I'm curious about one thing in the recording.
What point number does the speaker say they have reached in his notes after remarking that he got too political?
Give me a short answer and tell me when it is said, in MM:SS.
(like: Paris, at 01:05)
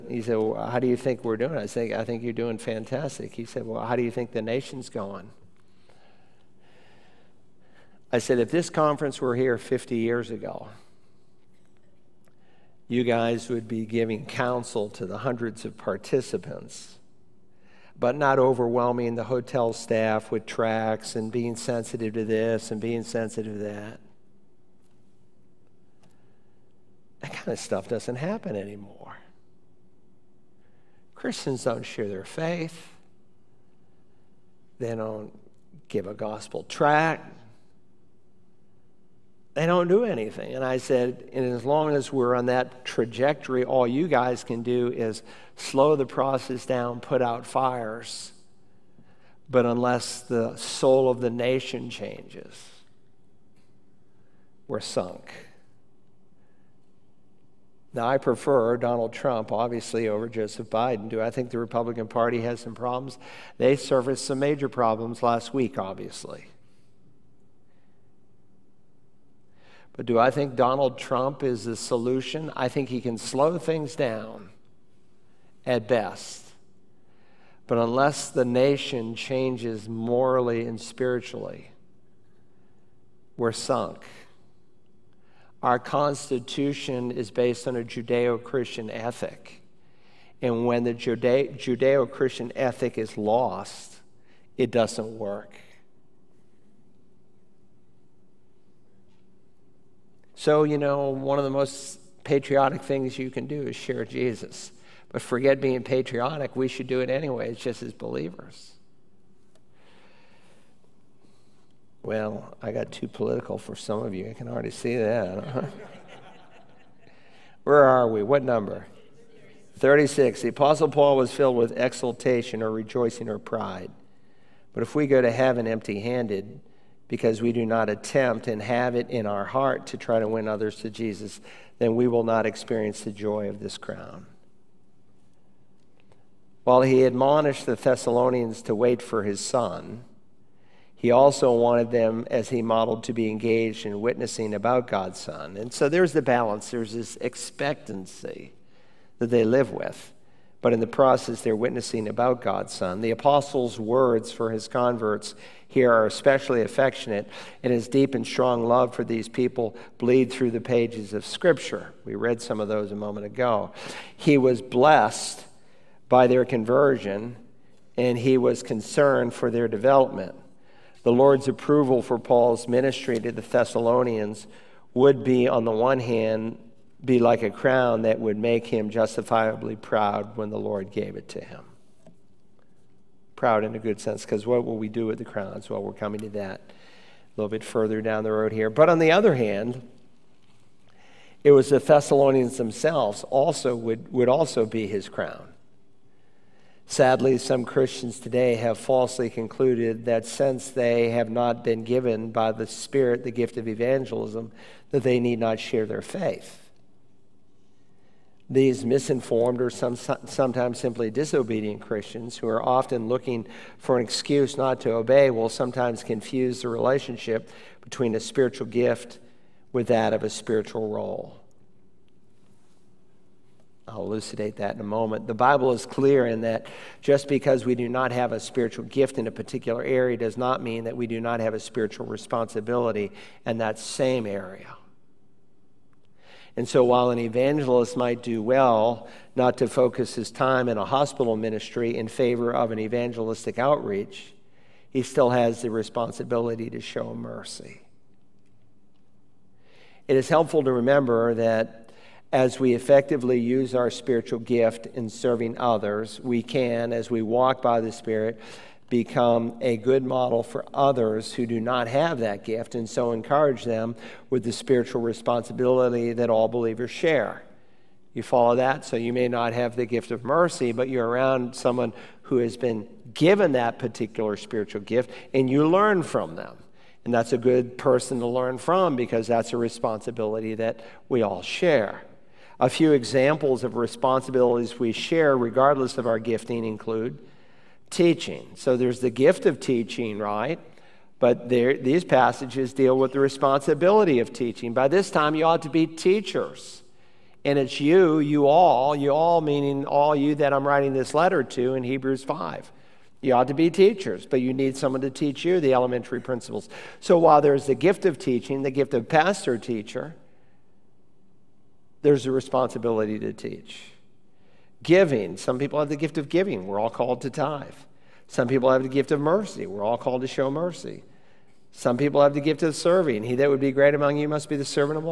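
36, at 01:59.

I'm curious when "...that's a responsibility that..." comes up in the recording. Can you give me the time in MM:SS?
04:39.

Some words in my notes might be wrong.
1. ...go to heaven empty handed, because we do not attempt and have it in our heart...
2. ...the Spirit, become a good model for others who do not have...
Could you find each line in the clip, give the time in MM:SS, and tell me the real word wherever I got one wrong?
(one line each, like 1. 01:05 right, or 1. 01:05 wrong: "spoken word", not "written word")
1. 02:05 right
2. 04:17 right.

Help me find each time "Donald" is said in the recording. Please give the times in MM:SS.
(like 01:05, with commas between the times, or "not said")
00:58, 01:10.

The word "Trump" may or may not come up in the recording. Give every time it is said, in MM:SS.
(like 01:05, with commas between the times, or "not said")
00:59, 01:10.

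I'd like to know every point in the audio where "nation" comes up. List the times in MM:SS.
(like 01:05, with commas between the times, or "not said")
00:04, 00:51, 01:18.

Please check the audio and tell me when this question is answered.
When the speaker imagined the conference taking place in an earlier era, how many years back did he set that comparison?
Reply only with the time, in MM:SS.
00:09.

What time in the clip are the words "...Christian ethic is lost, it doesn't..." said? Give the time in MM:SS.
01:32.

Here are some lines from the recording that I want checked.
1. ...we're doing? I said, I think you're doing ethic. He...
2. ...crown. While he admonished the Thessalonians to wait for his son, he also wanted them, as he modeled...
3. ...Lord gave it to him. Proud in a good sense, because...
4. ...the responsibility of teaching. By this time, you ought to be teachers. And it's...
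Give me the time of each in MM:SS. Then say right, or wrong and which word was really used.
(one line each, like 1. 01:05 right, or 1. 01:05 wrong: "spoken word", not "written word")
1. 00:01 wrong: "fantastic", not "ethic"
2. 02:13 right
3. 03:00 right
4. 04:53 right.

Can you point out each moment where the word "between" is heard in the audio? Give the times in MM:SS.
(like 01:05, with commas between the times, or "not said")
03:37.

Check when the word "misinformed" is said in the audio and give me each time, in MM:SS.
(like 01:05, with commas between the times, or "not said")
03:28.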